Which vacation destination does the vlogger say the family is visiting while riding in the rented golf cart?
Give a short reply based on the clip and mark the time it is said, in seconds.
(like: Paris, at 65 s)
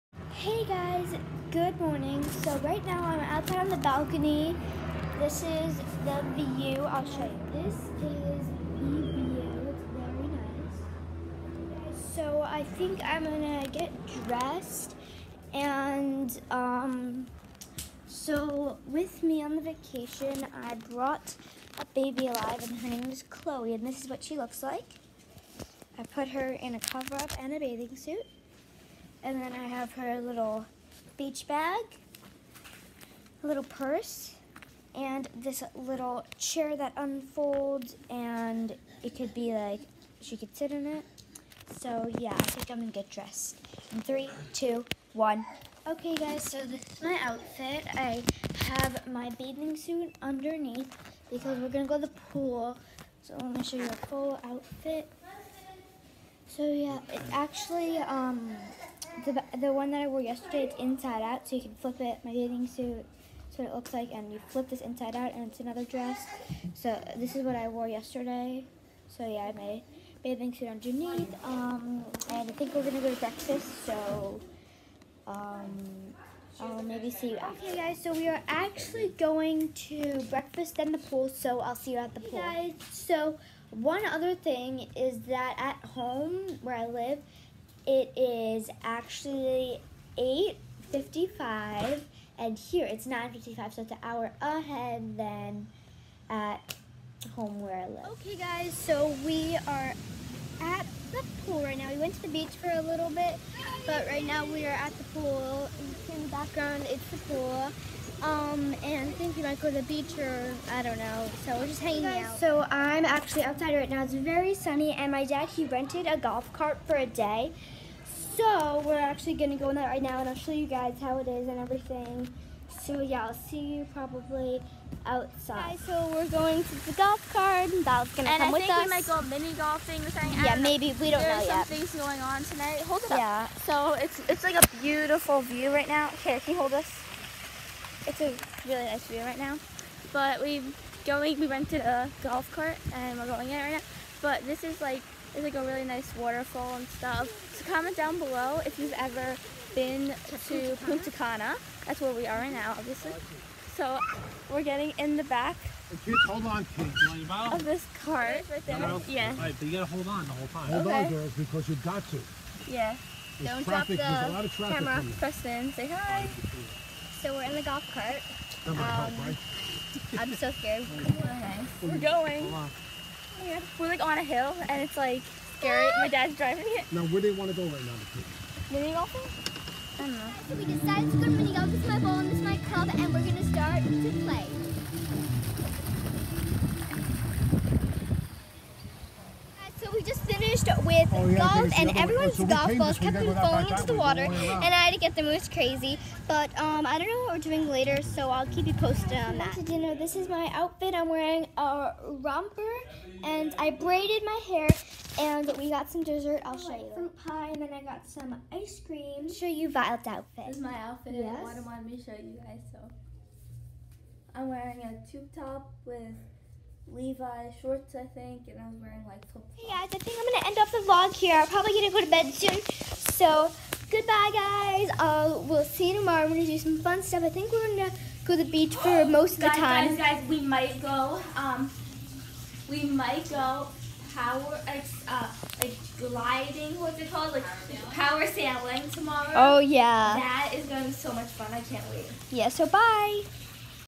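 Punta Cana, at 150 s.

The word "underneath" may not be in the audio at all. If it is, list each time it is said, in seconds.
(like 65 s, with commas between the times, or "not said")
50 s, 70 s.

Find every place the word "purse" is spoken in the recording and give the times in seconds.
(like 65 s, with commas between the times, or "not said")
33 s.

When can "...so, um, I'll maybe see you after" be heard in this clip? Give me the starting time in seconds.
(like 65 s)
73 s.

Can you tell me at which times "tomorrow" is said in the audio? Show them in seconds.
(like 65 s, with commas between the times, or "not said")
225 s, 238 s.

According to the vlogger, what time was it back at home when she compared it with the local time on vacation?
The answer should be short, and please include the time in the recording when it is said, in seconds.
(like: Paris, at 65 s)
8:55, at 90 s.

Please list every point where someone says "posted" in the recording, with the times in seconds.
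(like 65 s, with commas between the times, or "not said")
198 s.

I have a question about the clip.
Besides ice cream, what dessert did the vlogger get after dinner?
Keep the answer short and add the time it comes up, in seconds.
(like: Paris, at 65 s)
Fruit pie, at 206 s.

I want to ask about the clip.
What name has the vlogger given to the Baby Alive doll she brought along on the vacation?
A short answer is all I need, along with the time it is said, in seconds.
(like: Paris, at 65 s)
Chloe, at 23 s.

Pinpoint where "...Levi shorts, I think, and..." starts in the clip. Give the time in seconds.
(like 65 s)
216 s.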